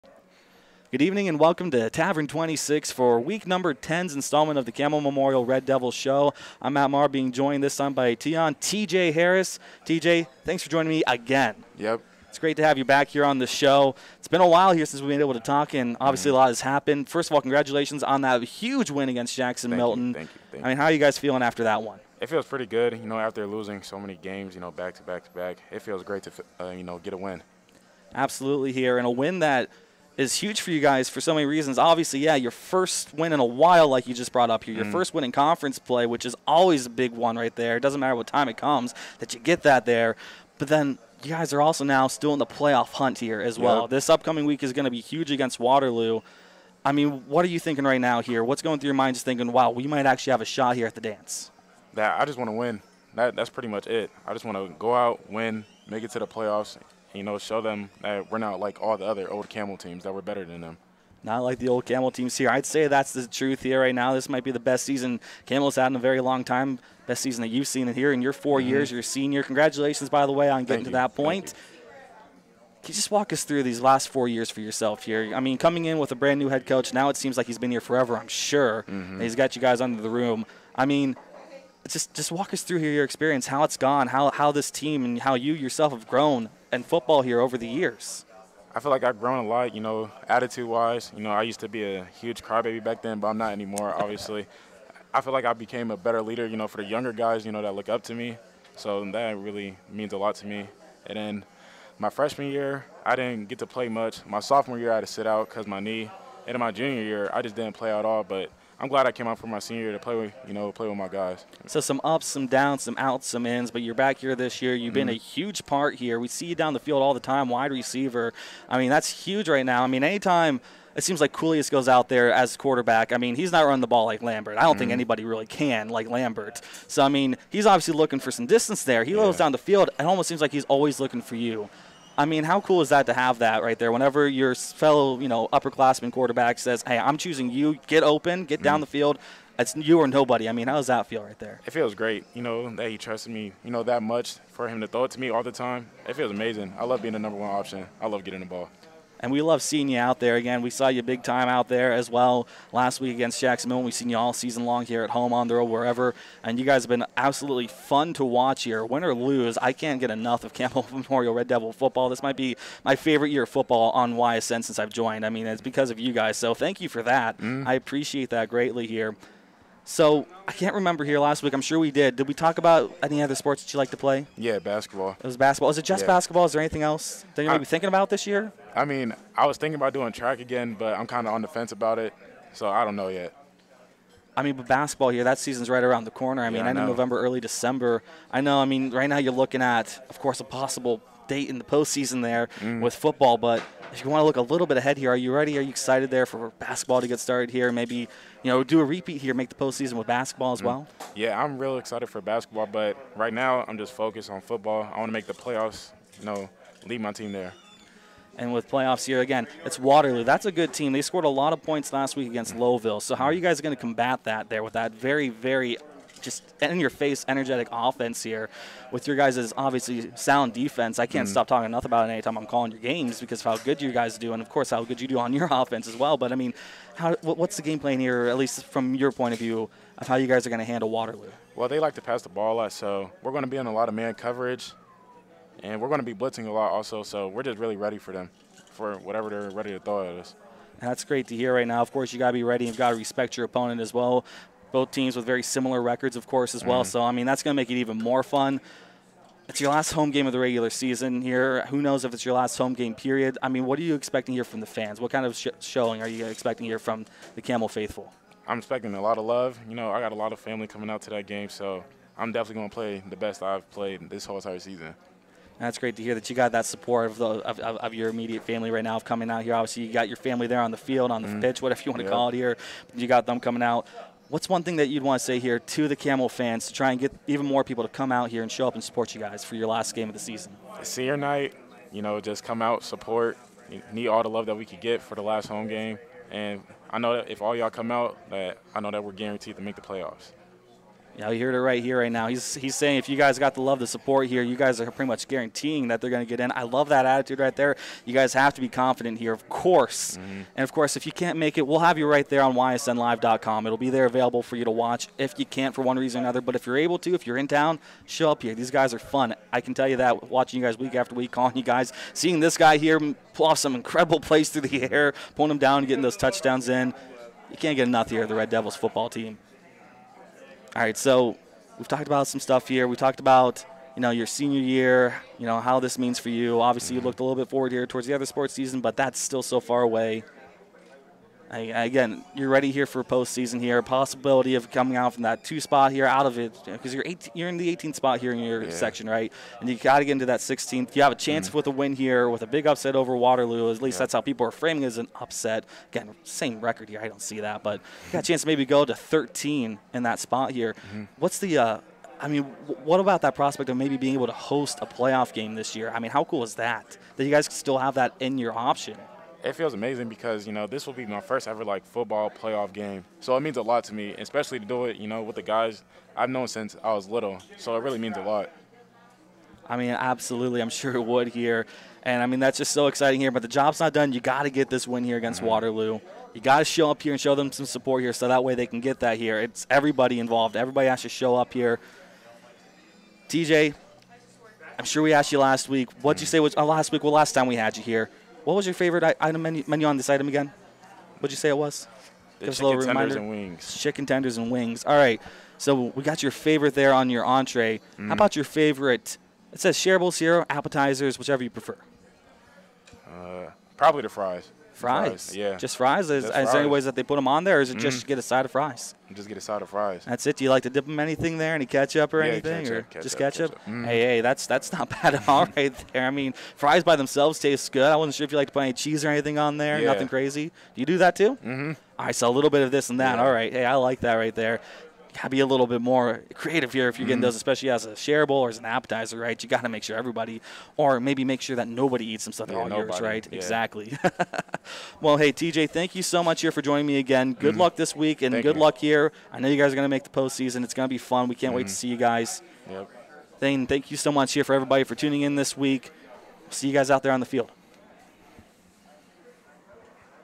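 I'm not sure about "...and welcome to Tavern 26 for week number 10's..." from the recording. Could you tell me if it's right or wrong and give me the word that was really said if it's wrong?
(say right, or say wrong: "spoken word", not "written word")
right.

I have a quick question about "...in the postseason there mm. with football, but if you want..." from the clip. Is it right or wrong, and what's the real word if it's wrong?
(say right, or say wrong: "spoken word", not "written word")
right.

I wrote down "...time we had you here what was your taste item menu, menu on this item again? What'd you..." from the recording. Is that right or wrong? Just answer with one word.
wrong.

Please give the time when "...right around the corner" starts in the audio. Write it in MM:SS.
03:05.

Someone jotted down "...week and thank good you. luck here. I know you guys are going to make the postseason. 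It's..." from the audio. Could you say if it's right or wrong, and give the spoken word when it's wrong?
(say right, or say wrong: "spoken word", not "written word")
right.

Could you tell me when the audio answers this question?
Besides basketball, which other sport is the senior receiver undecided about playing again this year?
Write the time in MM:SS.
03:00.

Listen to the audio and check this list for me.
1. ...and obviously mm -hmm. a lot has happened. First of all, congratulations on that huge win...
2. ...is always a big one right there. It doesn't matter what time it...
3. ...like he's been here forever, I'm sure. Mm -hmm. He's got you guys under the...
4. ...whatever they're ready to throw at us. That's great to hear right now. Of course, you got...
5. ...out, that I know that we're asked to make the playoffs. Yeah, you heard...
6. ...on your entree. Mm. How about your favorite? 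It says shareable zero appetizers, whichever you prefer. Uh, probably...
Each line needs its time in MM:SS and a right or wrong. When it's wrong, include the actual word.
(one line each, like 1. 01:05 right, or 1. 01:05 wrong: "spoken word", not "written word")
1. 00:15 right
2. 00:36 right
3. 01:17 right
4. 03:58 right
5. 04:47 wrong: "guaranteed", not "asked"
6. 06:36 right.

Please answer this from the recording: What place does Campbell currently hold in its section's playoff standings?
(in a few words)
18th.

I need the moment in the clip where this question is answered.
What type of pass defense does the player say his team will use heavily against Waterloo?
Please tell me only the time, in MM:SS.
03:53.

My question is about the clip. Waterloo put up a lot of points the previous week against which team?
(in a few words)
Lowville.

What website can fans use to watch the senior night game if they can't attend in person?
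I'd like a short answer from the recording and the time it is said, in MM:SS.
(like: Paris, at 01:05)
ysnlive.com, at 05:02.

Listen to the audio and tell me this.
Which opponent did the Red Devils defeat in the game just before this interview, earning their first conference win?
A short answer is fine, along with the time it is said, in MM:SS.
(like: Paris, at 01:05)
Jacksonville, at 02:33.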